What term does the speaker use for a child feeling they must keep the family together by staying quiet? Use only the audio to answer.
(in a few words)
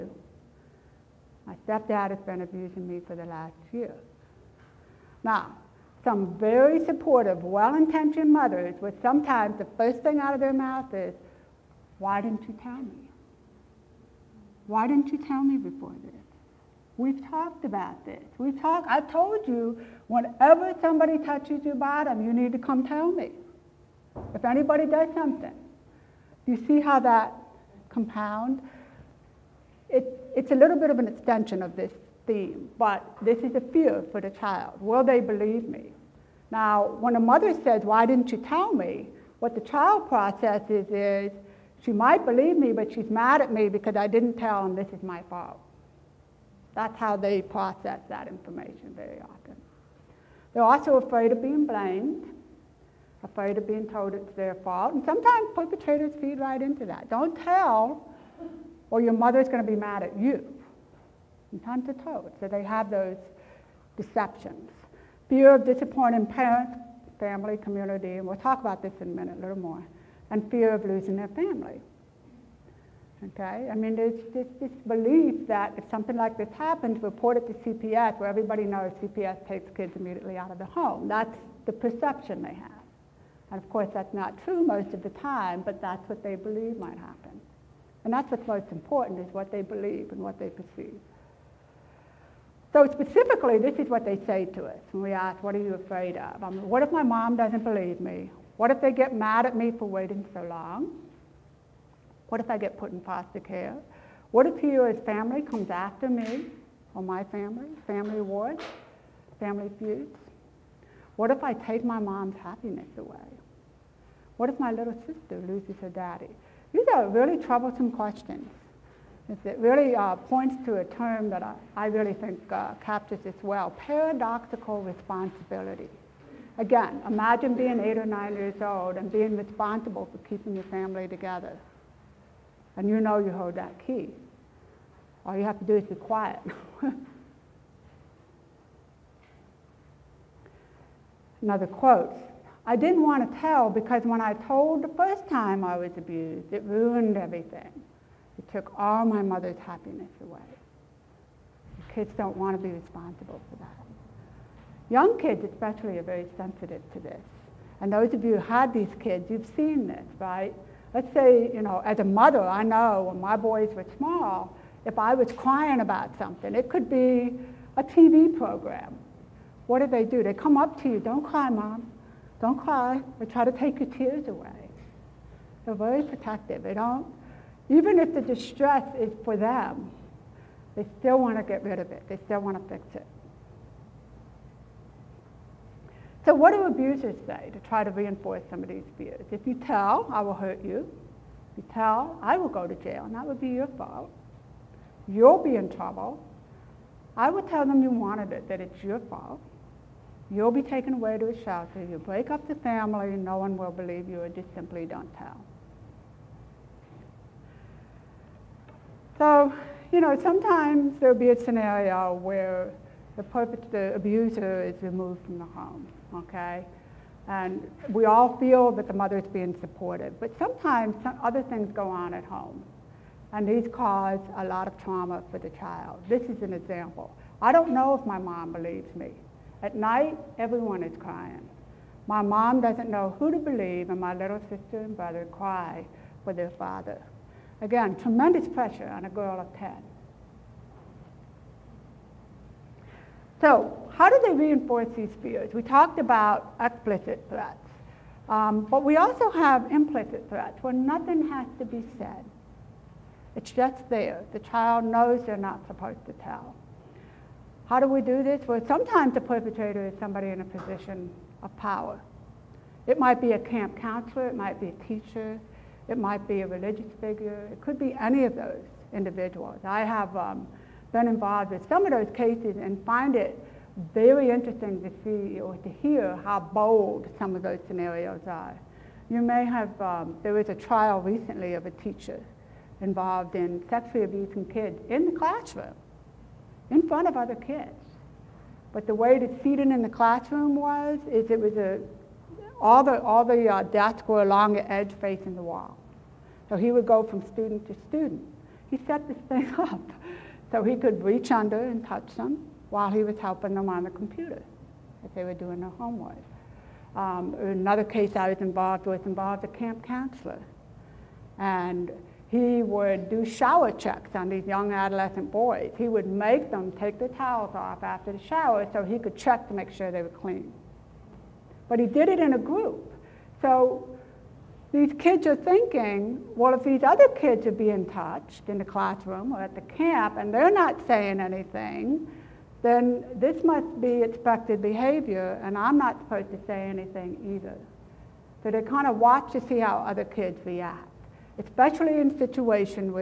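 paradoxical responsibility.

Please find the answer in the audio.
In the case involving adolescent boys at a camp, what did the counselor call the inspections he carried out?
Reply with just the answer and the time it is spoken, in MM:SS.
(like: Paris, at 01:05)
shower checks, at 05:13.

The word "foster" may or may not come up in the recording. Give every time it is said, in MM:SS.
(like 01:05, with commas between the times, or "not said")
01:43.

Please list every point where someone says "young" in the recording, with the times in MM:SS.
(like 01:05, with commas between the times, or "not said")
02:34, 05:14.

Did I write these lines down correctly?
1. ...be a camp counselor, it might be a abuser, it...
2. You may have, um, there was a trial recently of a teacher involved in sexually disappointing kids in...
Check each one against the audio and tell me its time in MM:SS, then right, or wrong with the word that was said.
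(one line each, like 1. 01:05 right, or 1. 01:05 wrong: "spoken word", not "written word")
1. 04:23 wrong: "teacher", not "abuser"
2. 04:39 wrong: "abusing", not "disappointing".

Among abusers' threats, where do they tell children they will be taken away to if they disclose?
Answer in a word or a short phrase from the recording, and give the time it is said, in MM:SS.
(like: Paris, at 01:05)
a shelter, at 03:21.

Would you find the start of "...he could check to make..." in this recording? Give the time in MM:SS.
05:18.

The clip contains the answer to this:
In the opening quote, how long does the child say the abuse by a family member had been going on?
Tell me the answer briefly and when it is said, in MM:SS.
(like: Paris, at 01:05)
the last year, at 00:03.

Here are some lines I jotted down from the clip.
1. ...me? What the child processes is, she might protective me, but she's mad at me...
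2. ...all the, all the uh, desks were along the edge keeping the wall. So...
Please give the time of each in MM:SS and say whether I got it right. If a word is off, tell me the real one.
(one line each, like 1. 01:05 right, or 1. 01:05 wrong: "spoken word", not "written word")
1. 00:38 wrong: "believe", not "protective"
2. 04:52 wrong: "facing", not "keeping".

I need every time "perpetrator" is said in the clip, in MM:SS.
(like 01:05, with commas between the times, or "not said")
00:55, 03:33, 04:19.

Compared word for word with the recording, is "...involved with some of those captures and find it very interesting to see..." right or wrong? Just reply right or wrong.
wrong.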